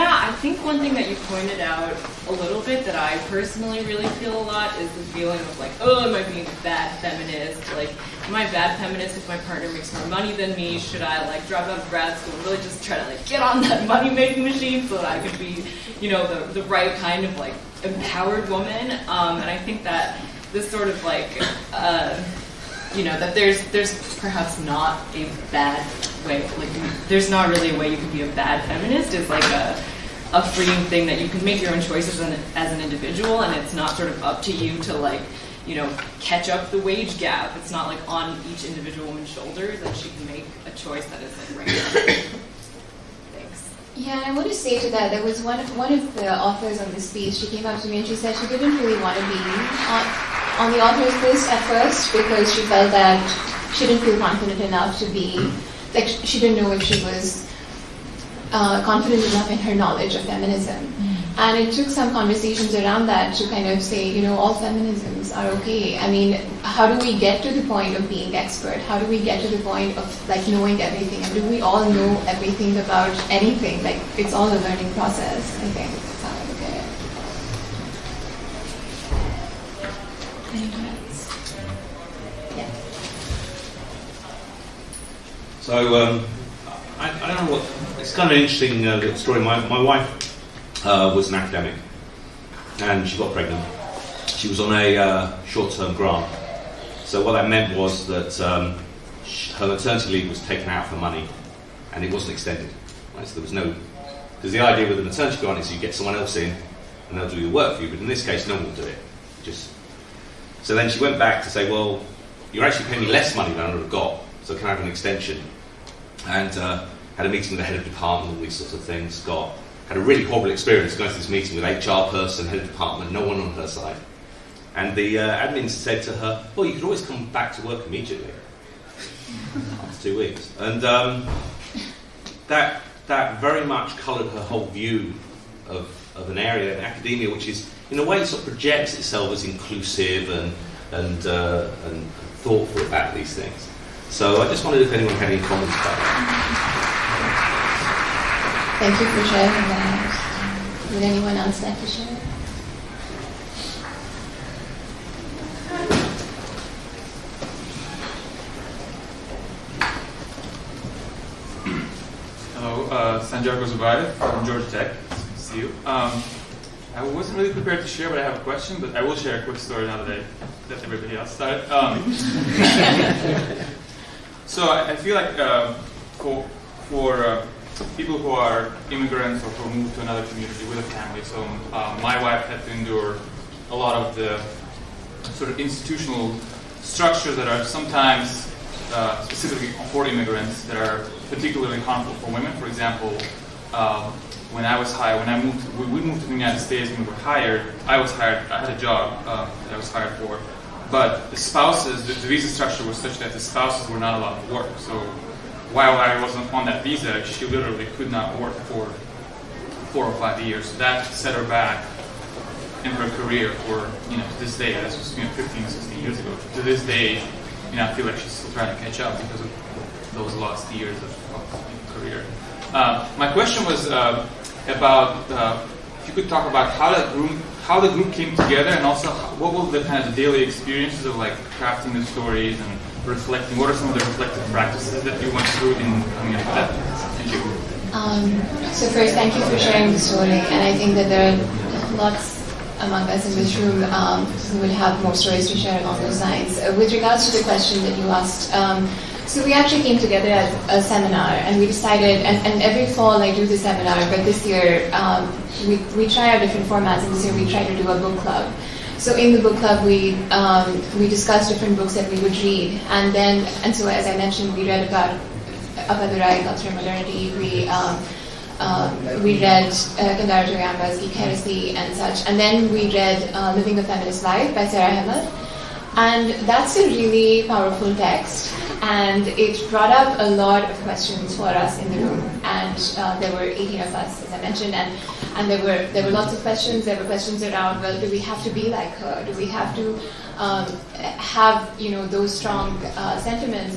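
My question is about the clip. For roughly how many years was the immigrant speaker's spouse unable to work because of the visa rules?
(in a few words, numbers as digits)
4 or 5 years.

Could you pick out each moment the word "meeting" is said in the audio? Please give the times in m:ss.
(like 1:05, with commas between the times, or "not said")
1:57, 2:01.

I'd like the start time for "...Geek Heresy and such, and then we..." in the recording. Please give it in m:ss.
4:30.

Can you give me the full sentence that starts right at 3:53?
What are some of the reflective practices that you went through in coming up with that?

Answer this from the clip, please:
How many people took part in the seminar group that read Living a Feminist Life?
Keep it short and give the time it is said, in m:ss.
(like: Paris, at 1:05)
18, at 4:43.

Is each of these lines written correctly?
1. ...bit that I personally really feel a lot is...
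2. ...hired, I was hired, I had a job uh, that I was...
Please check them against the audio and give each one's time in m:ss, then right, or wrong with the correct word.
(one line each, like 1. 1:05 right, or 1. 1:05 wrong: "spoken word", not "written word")
1. 0:02 right
2. 3:17 right.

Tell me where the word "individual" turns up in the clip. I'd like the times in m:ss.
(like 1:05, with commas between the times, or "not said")
0:32, 0:38.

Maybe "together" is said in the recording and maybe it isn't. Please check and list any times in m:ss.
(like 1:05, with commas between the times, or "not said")
3:48, 4:09.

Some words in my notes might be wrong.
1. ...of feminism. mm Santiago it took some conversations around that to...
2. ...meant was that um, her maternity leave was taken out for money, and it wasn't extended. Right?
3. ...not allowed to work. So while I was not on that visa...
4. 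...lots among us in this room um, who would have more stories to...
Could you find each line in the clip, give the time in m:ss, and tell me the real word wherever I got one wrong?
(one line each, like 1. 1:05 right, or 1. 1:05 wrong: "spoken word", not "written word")
1. 1:00 wrong: "And", not "Santiago"
2. 1:37 right
3. 3:23 right
4. 4:01 right.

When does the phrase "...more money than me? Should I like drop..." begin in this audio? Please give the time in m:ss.
0:09.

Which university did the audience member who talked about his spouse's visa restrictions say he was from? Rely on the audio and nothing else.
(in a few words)
Georgia Tech.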